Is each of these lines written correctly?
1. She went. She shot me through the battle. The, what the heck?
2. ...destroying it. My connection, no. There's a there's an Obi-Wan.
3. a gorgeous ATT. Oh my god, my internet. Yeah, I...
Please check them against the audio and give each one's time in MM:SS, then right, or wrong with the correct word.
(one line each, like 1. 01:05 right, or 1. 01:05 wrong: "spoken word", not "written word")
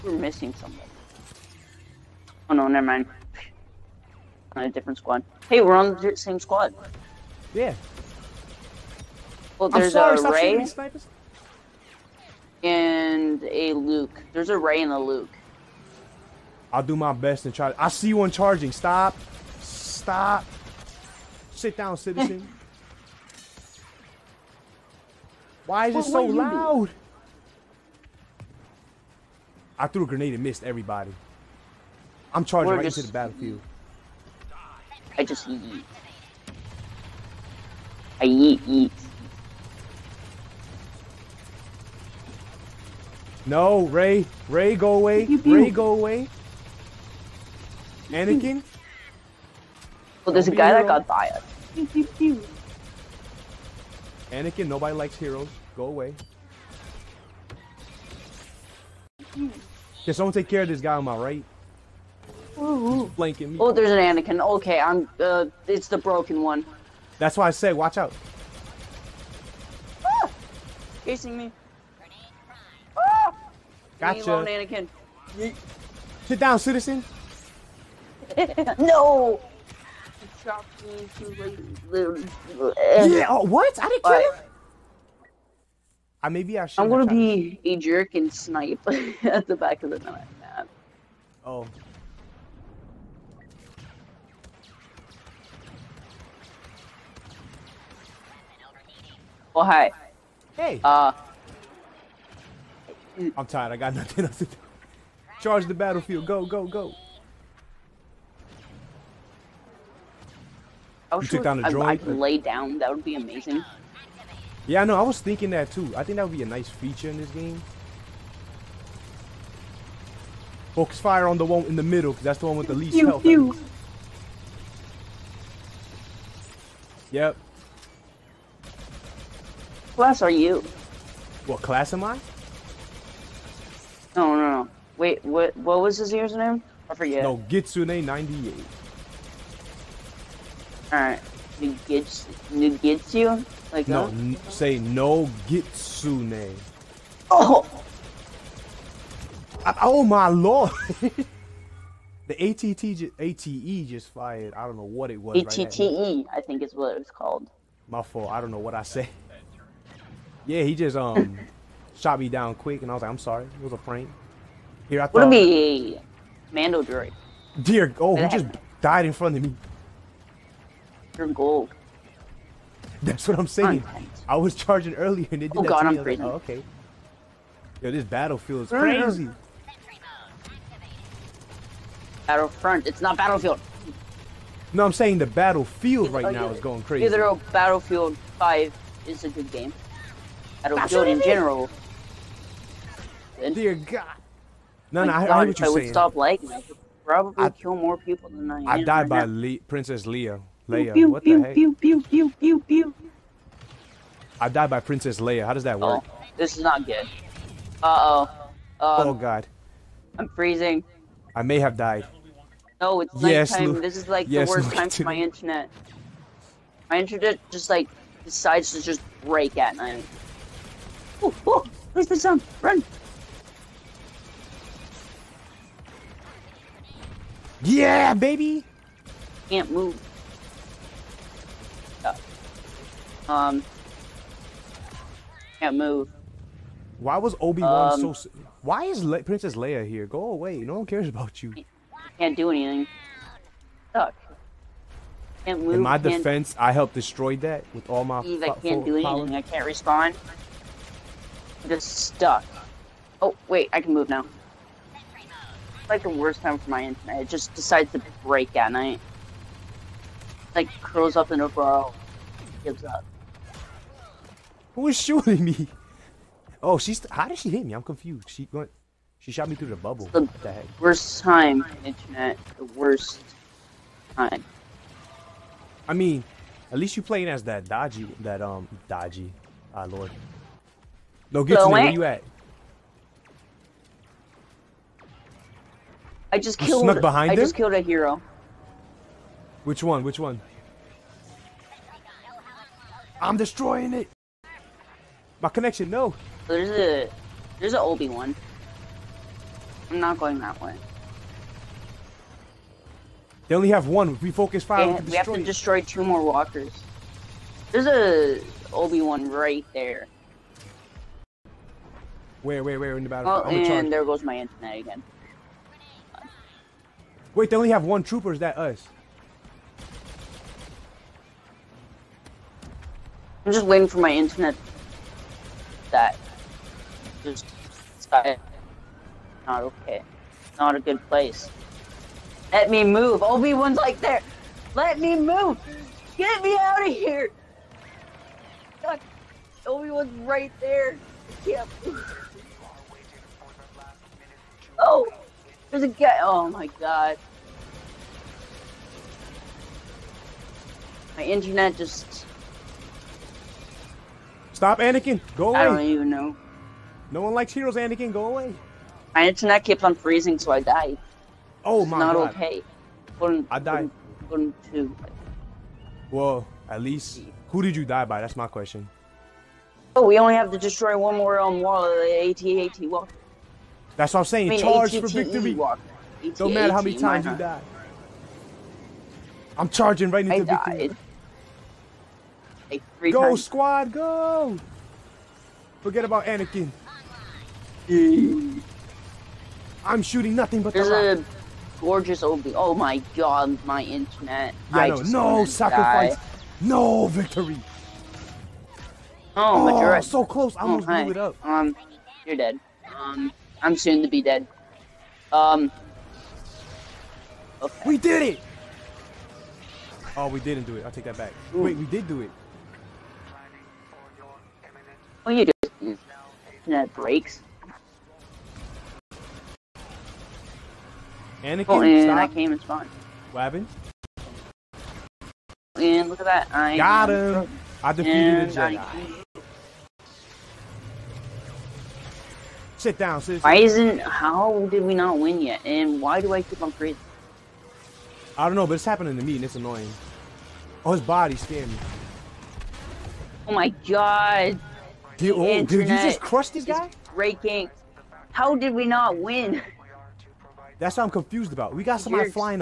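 1. 04:28 wrong: "bubble", not "battle"
2. 04:53 right
3. 06:31 wrong: "Obi", not "ATT".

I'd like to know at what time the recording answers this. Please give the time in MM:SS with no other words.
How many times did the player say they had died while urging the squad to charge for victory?
06:23.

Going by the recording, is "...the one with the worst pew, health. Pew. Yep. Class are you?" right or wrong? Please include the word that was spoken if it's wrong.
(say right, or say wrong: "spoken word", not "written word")
wrong: "least", not "worst".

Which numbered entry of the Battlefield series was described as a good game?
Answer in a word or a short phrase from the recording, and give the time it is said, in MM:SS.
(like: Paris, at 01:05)
5, at 03:07.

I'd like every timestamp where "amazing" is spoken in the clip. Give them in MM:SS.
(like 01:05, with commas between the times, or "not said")
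01:53.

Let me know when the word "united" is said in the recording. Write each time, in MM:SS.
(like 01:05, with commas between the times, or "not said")
not said.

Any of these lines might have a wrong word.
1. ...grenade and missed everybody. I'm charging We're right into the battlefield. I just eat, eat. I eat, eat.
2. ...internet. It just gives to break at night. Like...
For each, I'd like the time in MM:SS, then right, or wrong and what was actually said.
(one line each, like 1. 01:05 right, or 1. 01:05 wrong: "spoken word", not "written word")
1. 00:30 right
2. 04:16 wrong: "decides", not "gives".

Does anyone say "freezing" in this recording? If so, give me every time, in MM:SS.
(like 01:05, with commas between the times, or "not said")
03:30, 05:59.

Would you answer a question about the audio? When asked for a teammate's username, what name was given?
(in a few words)
Gitsune 98.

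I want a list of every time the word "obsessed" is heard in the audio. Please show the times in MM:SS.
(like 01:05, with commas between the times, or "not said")
not said.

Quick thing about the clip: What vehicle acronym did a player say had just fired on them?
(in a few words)
ATTE.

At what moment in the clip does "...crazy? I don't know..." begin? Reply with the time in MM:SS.
07:16.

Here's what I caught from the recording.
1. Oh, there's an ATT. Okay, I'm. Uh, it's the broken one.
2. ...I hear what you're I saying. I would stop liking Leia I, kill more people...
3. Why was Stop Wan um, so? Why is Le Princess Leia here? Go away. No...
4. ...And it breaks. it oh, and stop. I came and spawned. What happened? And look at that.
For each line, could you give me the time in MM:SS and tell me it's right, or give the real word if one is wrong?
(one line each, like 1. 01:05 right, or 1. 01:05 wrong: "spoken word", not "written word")
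1. 01:03 wrong: "Anakin", not "ATT"
2. 03:15 wrong: "Probably", not "Leia"
3. 03:56 wrong: "Obi", not "Stop"
4. 06:55 right.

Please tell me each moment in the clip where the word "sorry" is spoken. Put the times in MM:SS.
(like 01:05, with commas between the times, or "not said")
00:09, 02:43.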